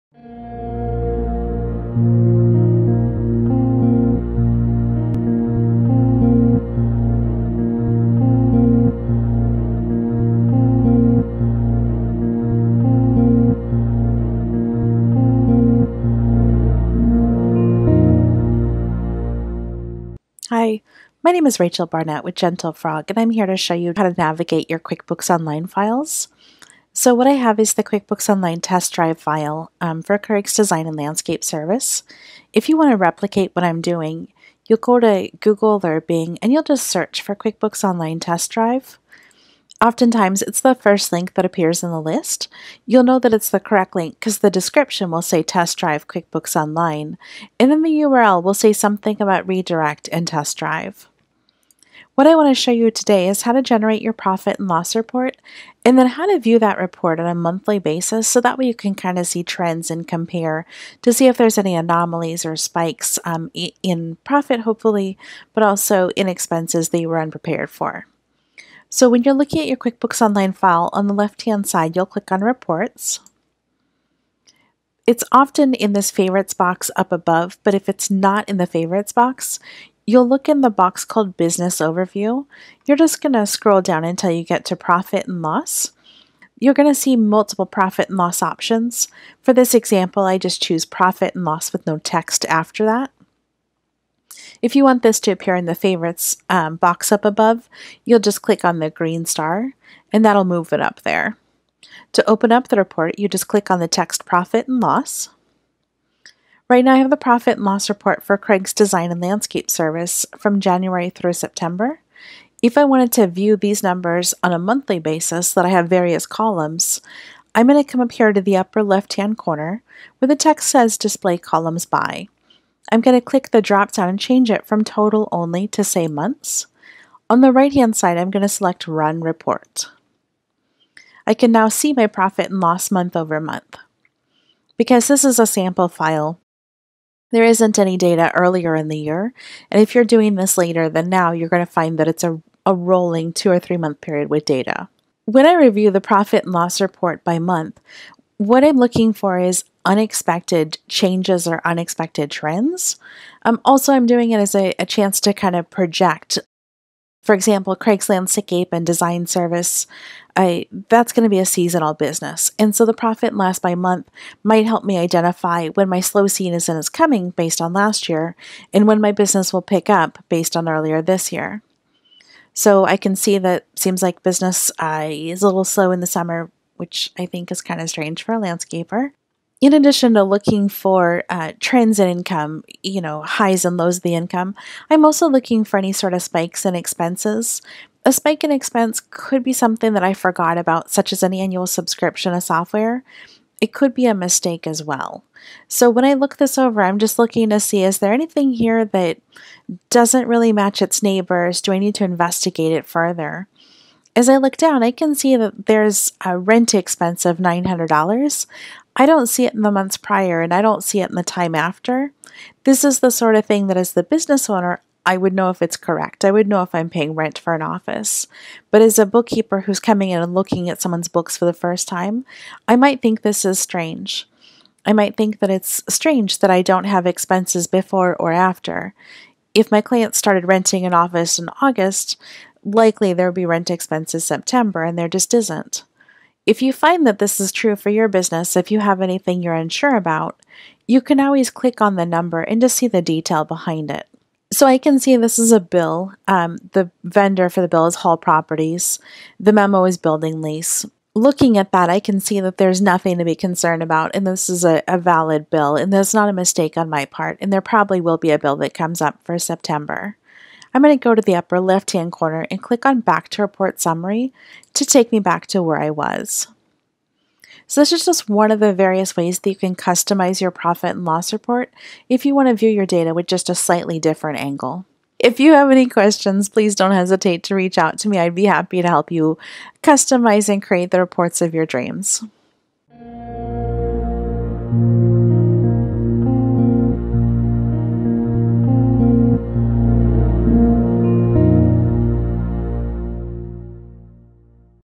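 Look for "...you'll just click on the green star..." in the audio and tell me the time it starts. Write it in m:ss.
1:38.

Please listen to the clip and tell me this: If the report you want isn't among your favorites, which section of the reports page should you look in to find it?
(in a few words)
Business Overview.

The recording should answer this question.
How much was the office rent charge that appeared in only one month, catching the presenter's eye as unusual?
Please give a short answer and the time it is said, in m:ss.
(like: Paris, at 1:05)
$900, at 3:27.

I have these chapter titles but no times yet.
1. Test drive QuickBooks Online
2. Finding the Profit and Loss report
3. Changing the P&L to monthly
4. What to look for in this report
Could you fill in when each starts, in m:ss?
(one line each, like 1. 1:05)
1. 0:20
2. 1:08
3. 1:52
4. 2:28.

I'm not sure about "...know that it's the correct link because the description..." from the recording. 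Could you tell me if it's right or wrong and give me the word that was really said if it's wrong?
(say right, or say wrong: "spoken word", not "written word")
right.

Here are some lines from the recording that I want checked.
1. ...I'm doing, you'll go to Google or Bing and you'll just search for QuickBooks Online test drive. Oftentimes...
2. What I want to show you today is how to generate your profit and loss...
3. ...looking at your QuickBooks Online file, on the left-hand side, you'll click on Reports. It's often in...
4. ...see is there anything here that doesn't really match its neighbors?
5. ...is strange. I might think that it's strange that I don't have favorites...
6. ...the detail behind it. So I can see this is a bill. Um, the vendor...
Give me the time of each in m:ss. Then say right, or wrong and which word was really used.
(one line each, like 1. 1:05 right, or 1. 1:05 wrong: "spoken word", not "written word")
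1. 0:33 right
2. 0:52 right
3. 1:09 right
4. 3:17 right
5. 3:43 wrong: "expenses", not "favorites"
6. 4:02 right.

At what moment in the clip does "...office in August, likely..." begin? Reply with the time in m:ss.
3:50.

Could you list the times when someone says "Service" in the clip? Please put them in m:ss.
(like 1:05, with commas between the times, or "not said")
0:31, 1:49, 2:39.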